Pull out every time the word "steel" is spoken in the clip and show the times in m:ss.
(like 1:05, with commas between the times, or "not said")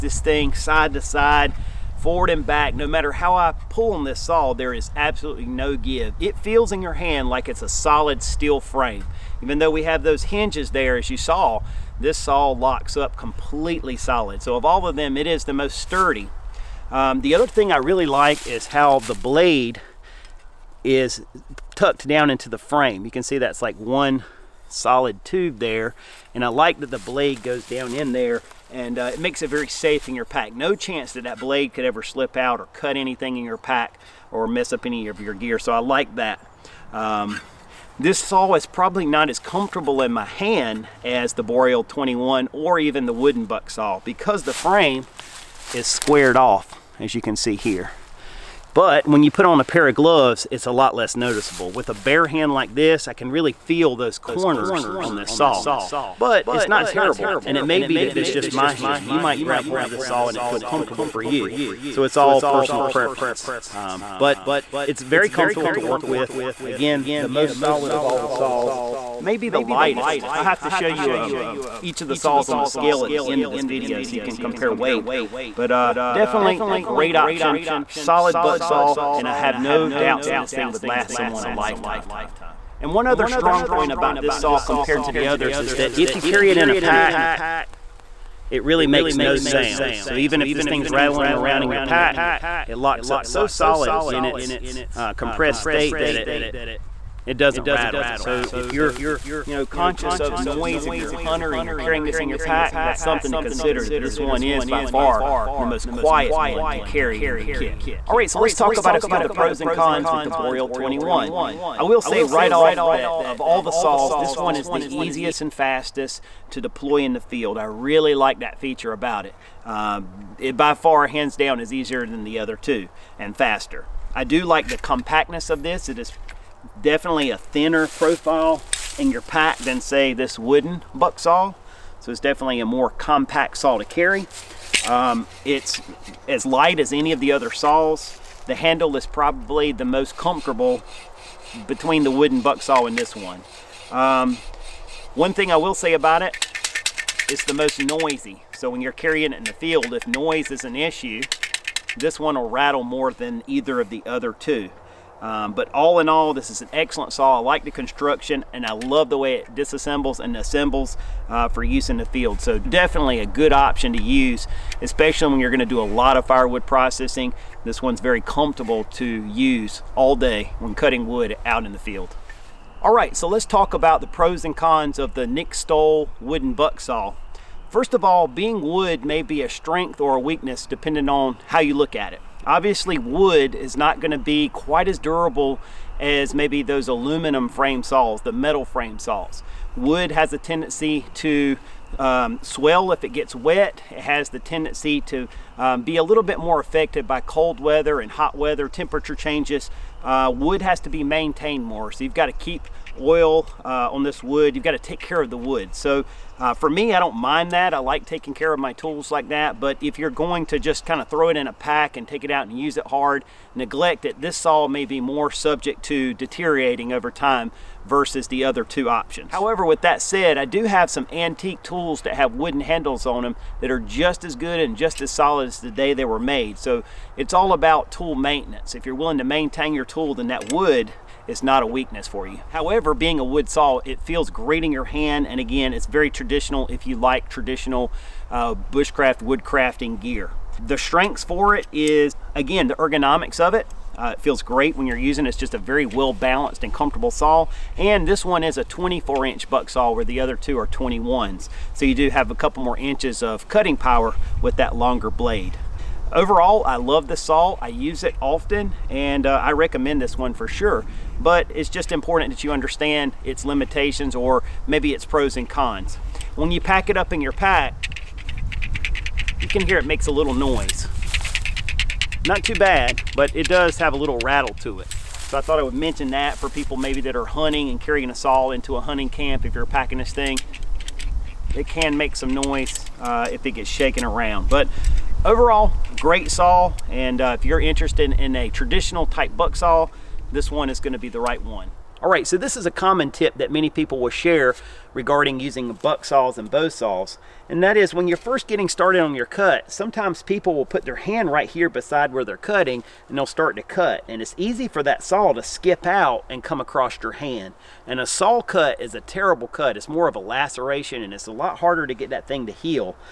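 0:08.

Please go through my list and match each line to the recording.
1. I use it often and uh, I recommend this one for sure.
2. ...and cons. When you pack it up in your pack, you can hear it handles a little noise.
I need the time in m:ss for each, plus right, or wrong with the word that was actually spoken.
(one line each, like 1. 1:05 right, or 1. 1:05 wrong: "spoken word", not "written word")
1. 4:17 right
2. 4:25 wrong: "makes", not "handles".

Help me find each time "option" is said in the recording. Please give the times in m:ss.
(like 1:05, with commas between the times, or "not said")
1:17, 2:43, 3:38.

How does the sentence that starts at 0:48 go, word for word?
But when you put on a pair of gloves, it's a lot less noticeable.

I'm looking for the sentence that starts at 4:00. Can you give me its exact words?
The strengths for it is, again, the ergonomics of it.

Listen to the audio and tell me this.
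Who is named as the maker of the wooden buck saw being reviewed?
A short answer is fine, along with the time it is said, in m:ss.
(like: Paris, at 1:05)
Nick Stowell, at 2:55.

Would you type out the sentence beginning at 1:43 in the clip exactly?
That this one is by far the most quiet one to carry in your kit.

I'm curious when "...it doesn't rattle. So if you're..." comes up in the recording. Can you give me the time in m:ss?
1:37.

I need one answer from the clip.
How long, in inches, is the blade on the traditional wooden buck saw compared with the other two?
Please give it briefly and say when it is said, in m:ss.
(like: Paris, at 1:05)
24 inches, at 4:08.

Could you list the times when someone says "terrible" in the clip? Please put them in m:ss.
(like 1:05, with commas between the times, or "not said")
0:56, 5:09.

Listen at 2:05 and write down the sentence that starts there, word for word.
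It is definitely a thinner profile in your pack than say this wooden buck saw.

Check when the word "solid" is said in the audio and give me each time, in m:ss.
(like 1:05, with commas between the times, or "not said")
0:07, 0:13, 0:24, 1:07, 1:17, 1:33, 3:45.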